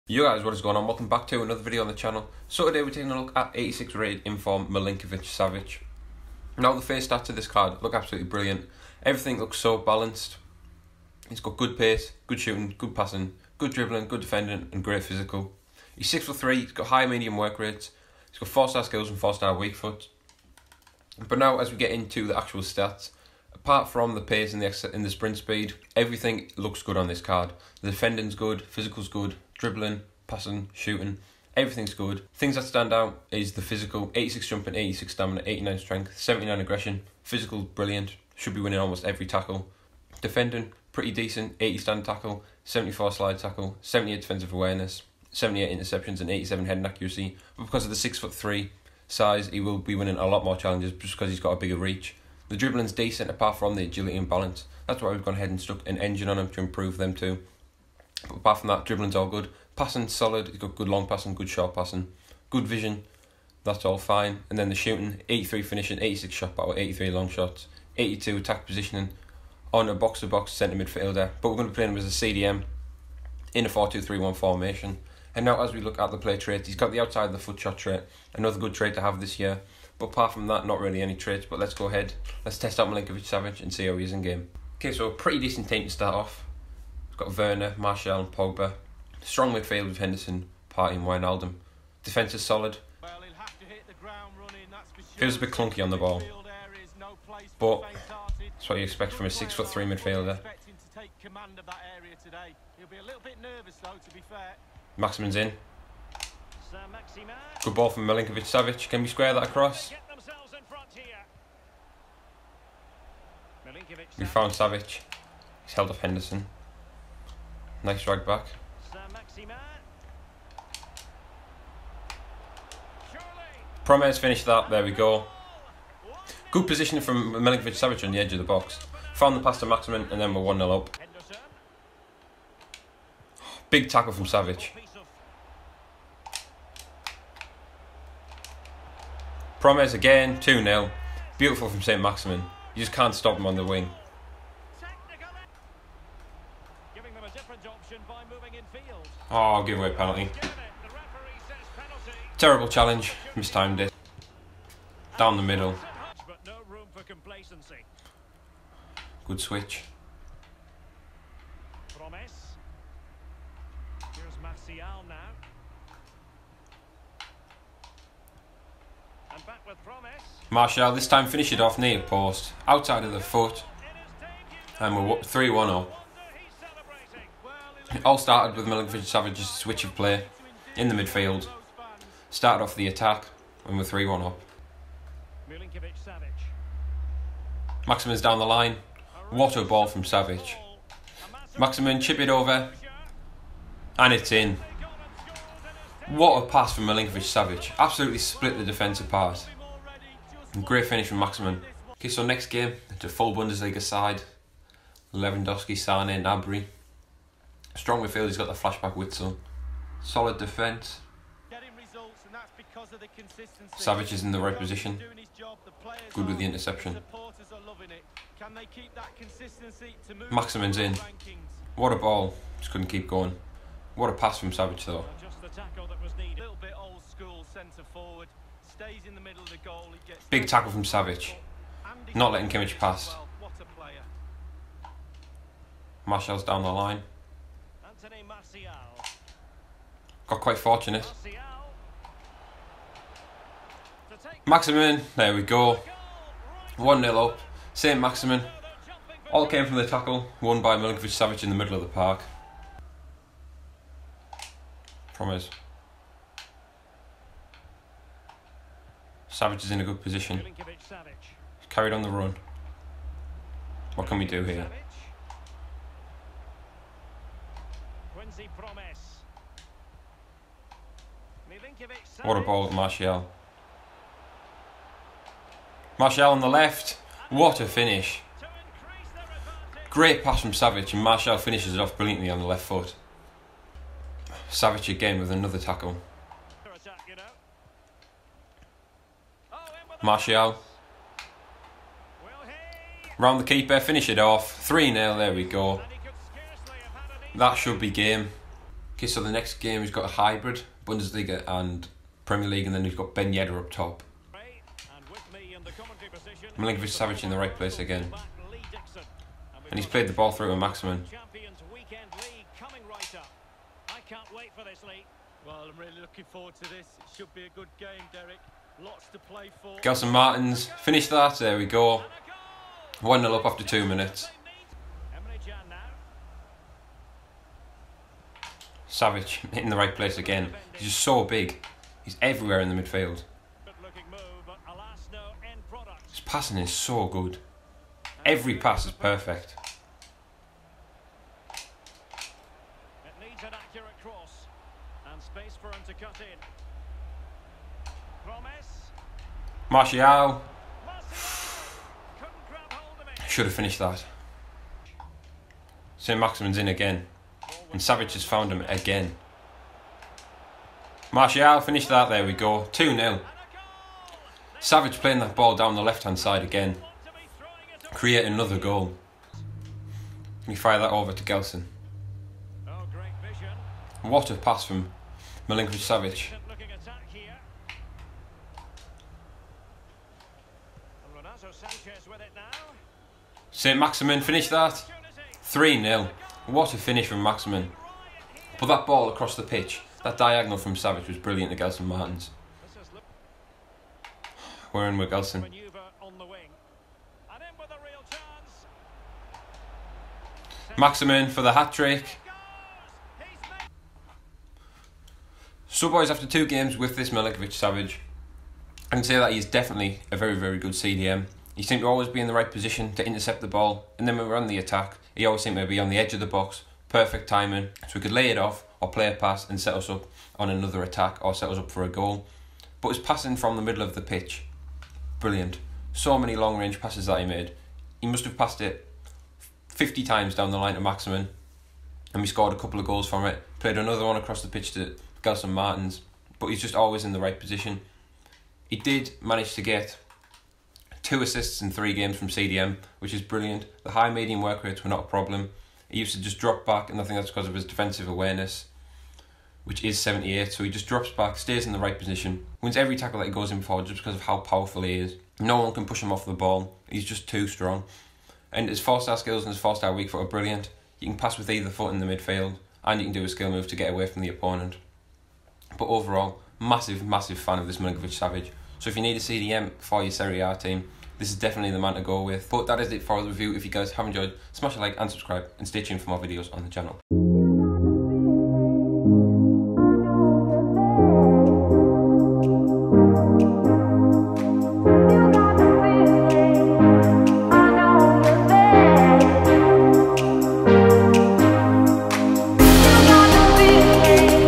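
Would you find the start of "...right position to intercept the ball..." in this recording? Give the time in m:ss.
6:52.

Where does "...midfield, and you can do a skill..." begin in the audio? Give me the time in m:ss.
7:42.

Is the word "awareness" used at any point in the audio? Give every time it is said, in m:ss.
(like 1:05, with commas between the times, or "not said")
0:44, 7:28.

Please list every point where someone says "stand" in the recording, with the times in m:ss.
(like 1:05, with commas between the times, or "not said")
0:32, 0:41.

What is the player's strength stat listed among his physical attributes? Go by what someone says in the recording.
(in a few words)
89.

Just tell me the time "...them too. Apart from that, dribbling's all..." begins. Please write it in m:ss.
0:56.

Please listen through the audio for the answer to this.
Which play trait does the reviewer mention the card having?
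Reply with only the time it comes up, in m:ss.
1:16.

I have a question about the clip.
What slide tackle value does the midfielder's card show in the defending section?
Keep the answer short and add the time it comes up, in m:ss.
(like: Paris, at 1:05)
74, at 0:42.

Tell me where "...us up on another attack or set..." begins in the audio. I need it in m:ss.
6:59.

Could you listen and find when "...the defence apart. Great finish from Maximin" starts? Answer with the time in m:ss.
3:18.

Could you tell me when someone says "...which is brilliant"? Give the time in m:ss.
7:22.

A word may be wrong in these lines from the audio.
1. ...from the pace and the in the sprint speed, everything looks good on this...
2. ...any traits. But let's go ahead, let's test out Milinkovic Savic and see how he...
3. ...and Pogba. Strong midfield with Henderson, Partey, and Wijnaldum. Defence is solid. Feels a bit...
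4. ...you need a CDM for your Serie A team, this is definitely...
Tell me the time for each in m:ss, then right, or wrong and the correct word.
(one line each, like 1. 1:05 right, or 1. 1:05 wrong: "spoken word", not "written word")
1. 0:23 right
2. 1:21 right
3. 1:28 right
4. 7:48 right.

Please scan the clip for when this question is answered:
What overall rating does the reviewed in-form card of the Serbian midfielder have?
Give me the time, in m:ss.
0:03.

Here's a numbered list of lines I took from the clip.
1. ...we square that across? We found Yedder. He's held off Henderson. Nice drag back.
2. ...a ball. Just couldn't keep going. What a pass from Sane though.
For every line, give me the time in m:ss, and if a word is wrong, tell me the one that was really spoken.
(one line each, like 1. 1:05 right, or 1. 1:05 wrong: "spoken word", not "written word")
1. 1:49 wrong: "Savic", not "Yedder"
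2. 3:41 wrong: "Savic", not "Sane".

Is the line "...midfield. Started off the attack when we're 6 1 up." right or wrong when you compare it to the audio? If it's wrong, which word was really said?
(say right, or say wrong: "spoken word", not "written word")
wrong: "3", not "6".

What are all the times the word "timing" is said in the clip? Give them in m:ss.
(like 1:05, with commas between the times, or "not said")
6:57.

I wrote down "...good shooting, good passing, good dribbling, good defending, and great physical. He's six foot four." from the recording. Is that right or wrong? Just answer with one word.
wrong.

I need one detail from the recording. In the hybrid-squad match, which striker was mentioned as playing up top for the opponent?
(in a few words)
Ben Yedder.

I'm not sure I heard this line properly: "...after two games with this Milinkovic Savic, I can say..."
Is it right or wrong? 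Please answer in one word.
right.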